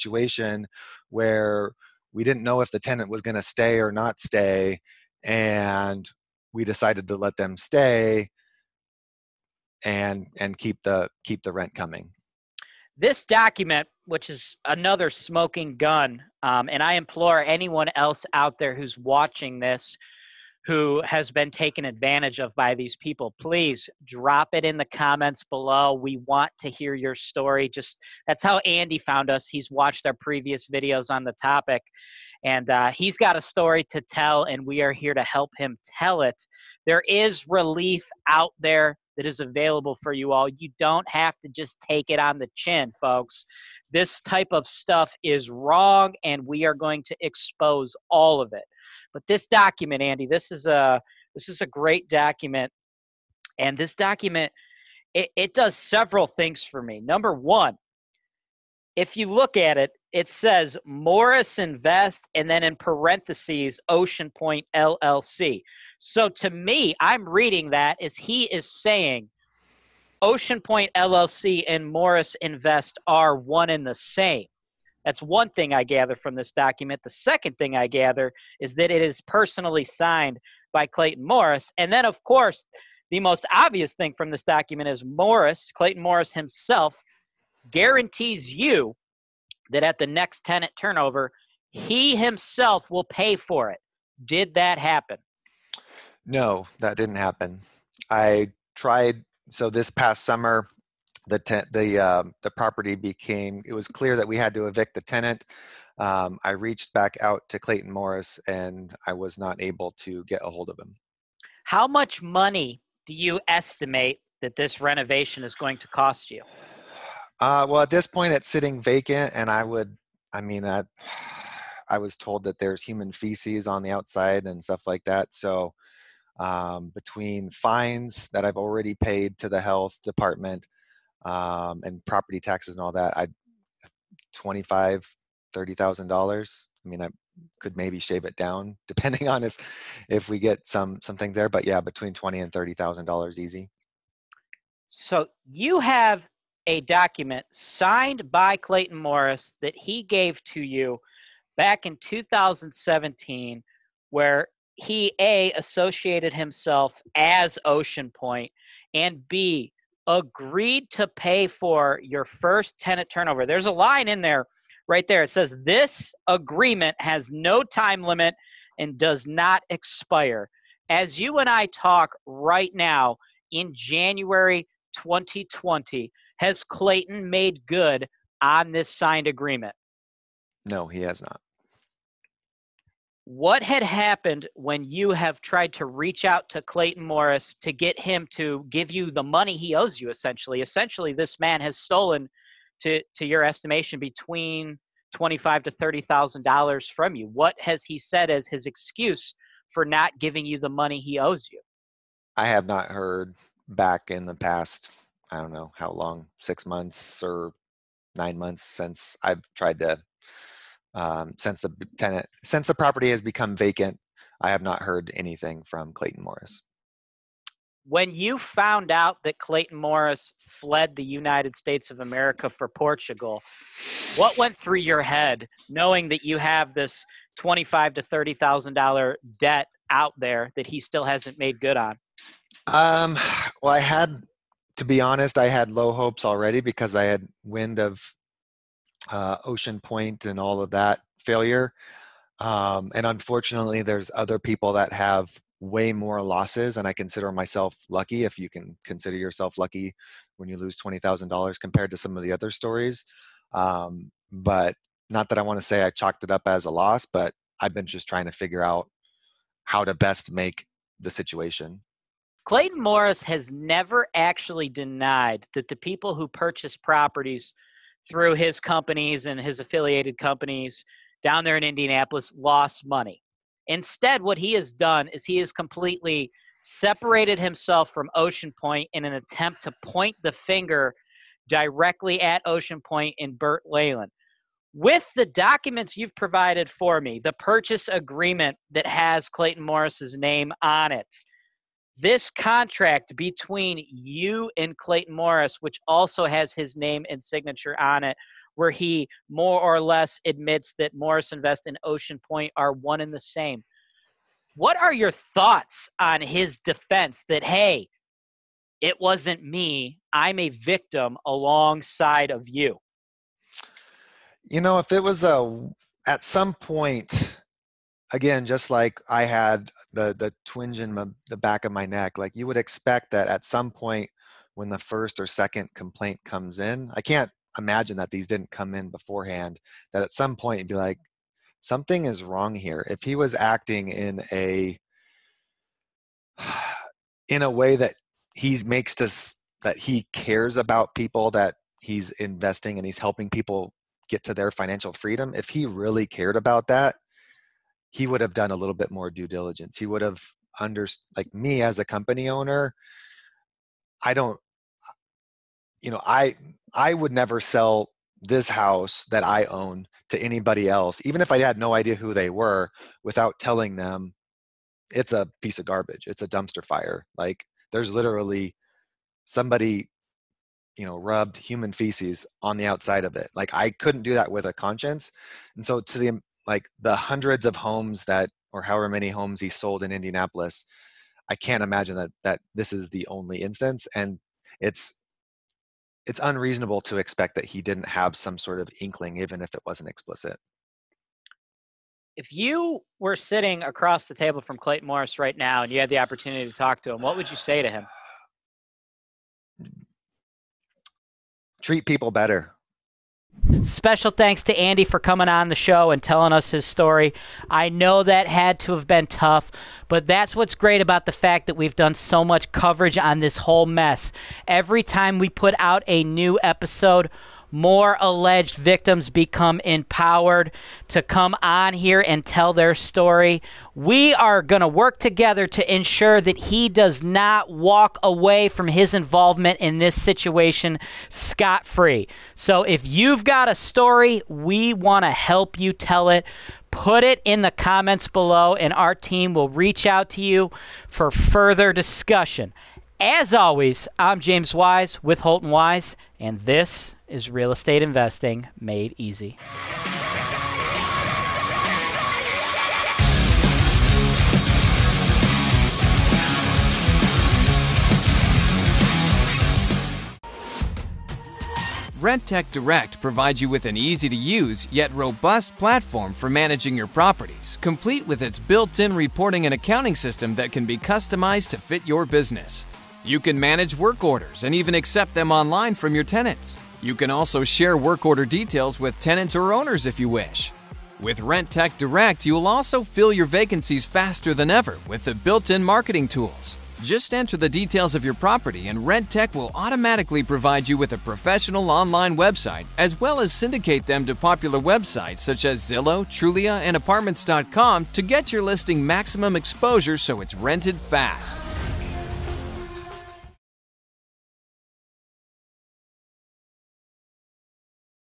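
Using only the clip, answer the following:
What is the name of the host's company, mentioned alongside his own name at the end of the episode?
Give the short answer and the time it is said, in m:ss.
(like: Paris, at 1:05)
Holton Wise, at 7:25.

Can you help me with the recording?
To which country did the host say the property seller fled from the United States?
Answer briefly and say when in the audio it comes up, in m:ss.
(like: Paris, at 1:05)
Portugal, at 3:42.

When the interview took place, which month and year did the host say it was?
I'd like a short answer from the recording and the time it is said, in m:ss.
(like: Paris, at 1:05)
January 2020, at 2:53.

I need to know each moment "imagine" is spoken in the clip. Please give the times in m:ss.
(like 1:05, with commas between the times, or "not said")
5:27, 6:21.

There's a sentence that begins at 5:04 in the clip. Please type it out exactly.
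What are your thoughts on his defense that, hey, it wasn't me, I'm a victim alongside of you?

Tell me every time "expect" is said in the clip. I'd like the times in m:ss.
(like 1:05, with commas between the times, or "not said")
5:22, 6:26.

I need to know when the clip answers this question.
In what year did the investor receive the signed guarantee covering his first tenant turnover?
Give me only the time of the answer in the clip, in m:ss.
2:31.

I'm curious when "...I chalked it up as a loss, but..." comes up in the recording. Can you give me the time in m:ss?
4:15.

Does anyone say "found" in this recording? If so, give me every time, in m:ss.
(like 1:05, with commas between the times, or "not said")
0:28, 3:38.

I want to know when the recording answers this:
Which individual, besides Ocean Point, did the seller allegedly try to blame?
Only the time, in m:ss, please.
4:43.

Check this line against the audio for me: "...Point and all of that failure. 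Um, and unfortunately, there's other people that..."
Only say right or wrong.
right.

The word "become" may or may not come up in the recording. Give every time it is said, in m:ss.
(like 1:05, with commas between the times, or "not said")
3:33, 6:59.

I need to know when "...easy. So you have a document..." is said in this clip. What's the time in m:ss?
2:23.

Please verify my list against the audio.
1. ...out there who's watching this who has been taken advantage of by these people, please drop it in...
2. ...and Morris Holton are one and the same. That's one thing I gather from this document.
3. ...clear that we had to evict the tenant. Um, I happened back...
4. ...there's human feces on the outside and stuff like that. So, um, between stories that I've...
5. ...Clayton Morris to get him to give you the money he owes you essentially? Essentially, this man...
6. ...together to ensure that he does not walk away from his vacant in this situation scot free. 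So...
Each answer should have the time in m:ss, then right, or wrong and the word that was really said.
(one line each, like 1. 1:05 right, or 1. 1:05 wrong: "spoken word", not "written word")
1. 0:18 right
2. 1:11 wrong: "Invest", not "Holton"
3. 1:43 wrong: "reached", not "happened"
4. 2:02 wrong: "fines", not "stories"
5. 3:06 right
6. 7:04 wrong: "involvement", not "vacant".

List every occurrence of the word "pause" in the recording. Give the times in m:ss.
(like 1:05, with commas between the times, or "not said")
not said.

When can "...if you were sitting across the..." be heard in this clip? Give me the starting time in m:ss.
6:32.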